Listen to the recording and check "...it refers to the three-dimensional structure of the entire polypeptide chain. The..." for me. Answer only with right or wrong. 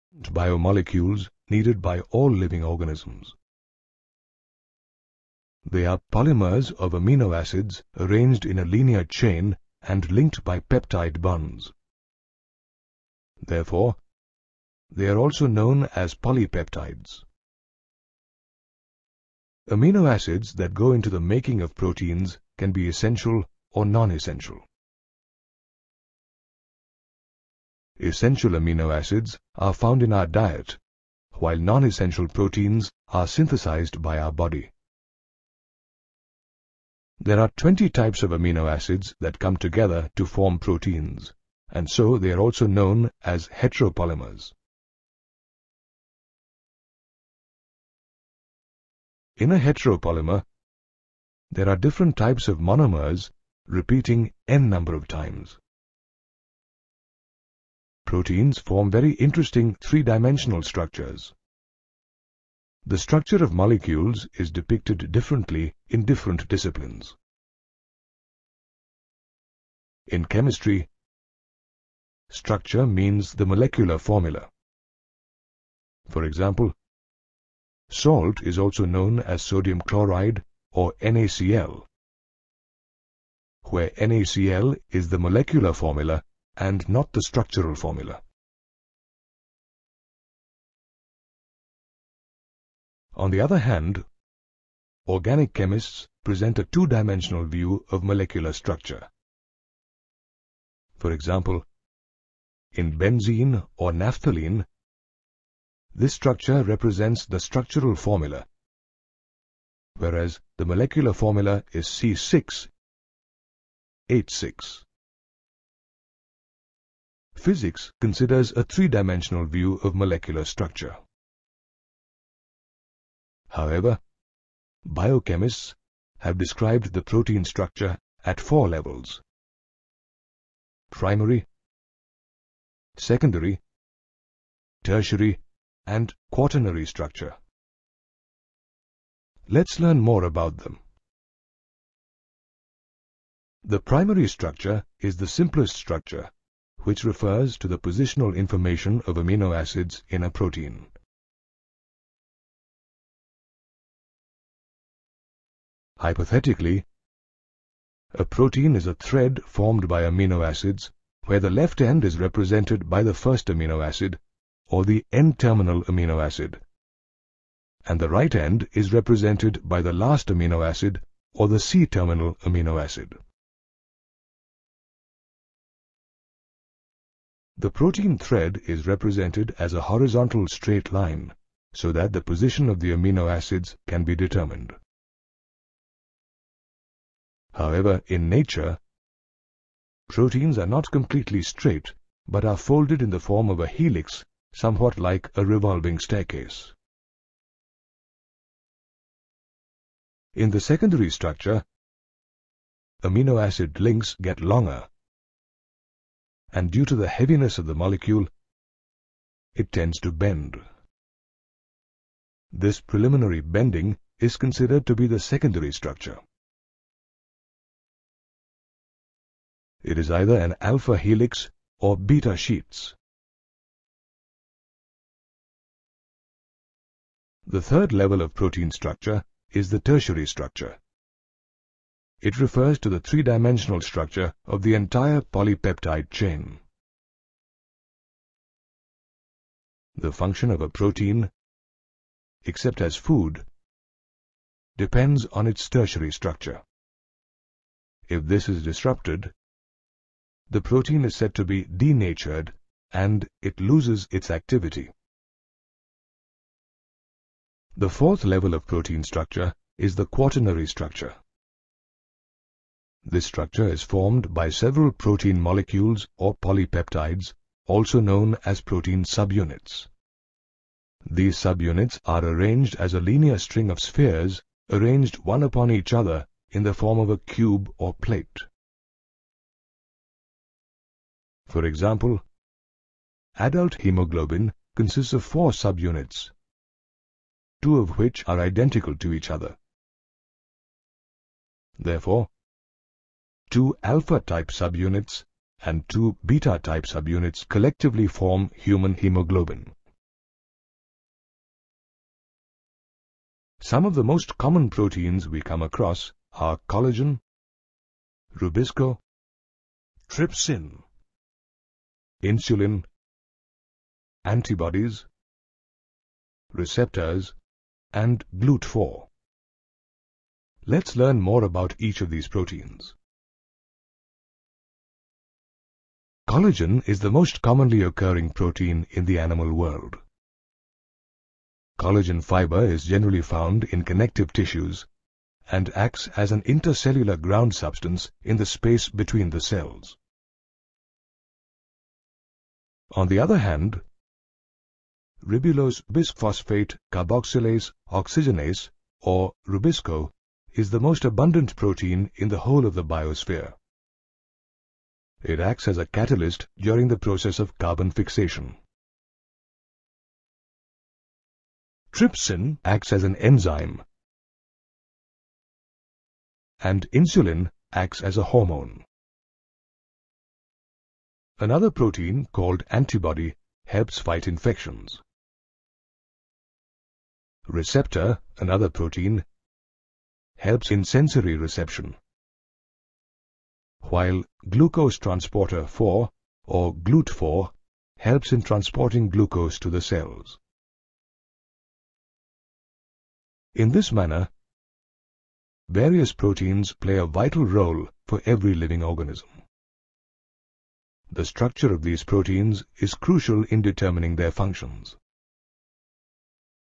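right.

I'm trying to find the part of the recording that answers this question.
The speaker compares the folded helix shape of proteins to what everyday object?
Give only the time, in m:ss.
3:15.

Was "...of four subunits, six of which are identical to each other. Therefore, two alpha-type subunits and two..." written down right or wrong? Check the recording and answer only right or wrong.
wrong.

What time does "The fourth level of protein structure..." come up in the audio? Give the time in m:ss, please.
4:17.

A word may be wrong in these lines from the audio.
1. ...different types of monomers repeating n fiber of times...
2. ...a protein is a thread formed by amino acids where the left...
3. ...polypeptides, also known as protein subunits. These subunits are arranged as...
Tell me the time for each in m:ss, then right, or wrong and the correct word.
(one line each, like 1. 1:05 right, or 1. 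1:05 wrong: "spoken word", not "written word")
1. 0:51 wrong: "number", not "fiber"
2. 2:38 right
3. 4:26 right.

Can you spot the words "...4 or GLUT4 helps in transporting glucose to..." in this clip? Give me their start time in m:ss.
6:25.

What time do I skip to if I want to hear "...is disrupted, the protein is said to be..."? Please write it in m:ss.
4:08.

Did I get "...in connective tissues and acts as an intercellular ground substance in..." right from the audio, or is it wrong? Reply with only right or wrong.
right.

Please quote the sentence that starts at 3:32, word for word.
This preliminary bending is considered to be the secondary structure.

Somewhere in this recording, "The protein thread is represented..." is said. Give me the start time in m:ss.
2:57.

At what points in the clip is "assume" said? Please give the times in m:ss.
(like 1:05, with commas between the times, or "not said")
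not said.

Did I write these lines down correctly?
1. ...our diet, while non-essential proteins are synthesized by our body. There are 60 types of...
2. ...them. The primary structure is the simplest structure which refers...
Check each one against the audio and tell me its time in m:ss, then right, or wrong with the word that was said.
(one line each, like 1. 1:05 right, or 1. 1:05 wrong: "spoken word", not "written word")
1. 0:30 wrong: "20", not "60"
2. 2:20 right.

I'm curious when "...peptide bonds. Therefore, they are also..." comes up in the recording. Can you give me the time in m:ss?
0:10.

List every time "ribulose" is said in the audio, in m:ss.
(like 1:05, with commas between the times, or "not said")
5:45.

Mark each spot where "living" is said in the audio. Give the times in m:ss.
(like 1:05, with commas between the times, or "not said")
0:02, 6:38.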